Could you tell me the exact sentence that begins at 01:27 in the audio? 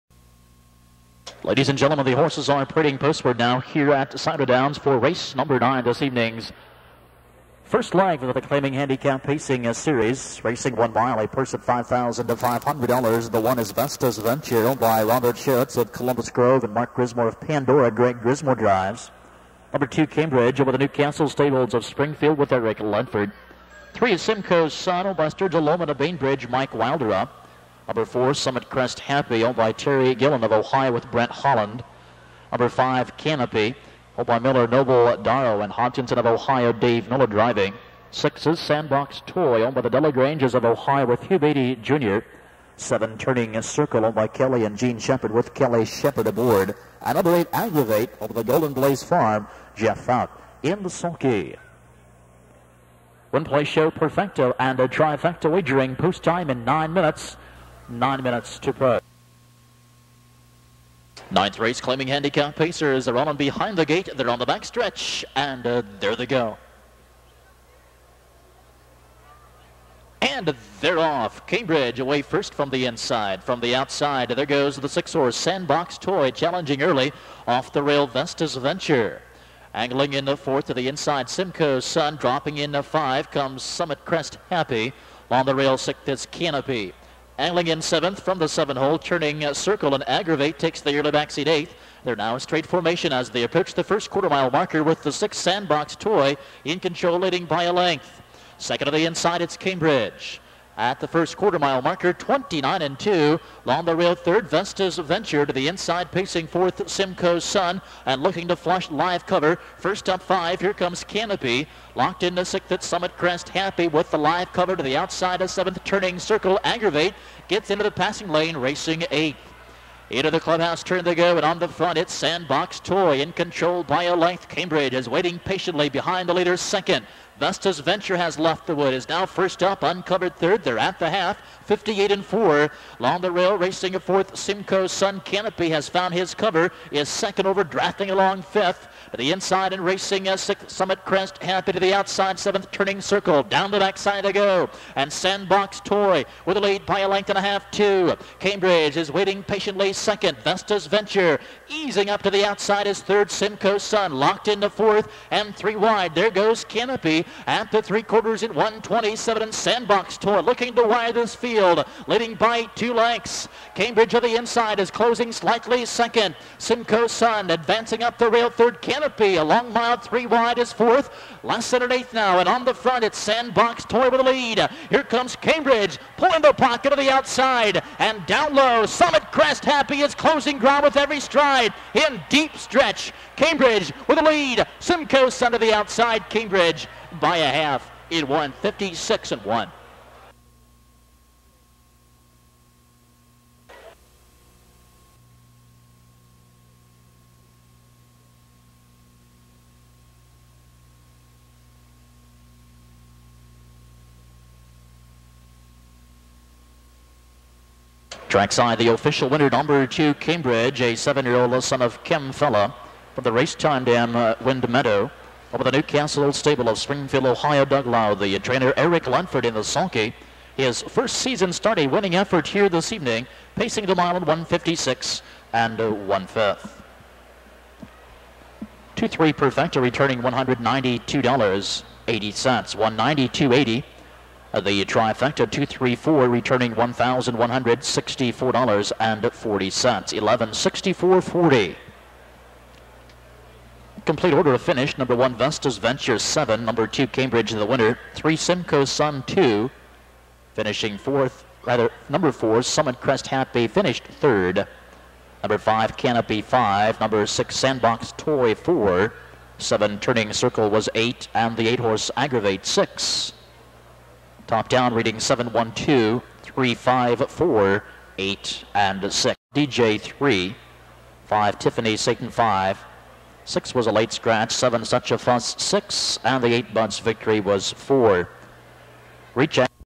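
Angling in seventh from the seven hole, turning circle and aggravate takes the early backseat eighth.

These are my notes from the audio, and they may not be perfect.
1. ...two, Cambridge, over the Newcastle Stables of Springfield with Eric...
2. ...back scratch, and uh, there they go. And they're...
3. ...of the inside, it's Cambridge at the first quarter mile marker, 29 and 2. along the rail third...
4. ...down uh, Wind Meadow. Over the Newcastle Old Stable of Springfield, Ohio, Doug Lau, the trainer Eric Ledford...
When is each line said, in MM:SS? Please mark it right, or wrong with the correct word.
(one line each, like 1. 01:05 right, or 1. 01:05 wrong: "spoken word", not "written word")
1. 00:19 right
2. 01:04 wrong: "stretch", not "scratch"
3. 01:38 right
4. 03:33 right.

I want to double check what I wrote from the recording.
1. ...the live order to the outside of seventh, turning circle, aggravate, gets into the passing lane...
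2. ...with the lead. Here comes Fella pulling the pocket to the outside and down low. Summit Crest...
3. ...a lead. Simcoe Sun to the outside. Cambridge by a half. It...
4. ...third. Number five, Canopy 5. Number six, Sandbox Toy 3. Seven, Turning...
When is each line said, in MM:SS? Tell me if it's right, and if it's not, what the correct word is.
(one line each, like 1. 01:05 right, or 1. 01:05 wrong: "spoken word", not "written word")
1. 01:54 wrong: "cover", not "order"
2. 02:54 wrong: "Cambridge", not "Fella"
3. 03:04 right
4. 04:14 wrong: "4", not "3".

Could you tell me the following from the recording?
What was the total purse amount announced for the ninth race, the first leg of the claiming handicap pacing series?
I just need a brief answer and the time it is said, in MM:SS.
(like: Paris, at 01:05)
$5,000, at 00:11.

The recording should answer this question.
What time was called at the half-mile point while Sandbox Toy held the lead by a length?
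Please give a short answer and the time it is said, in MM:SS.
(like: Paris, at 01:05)
58 and 4, at 02:11.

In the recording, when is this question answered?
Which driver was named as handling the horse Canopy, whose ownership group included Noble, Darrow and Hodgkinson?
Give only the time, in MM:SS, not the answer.
00:36.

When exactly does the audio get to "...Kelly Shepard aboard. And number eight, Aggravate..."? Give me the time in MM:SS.
00:45.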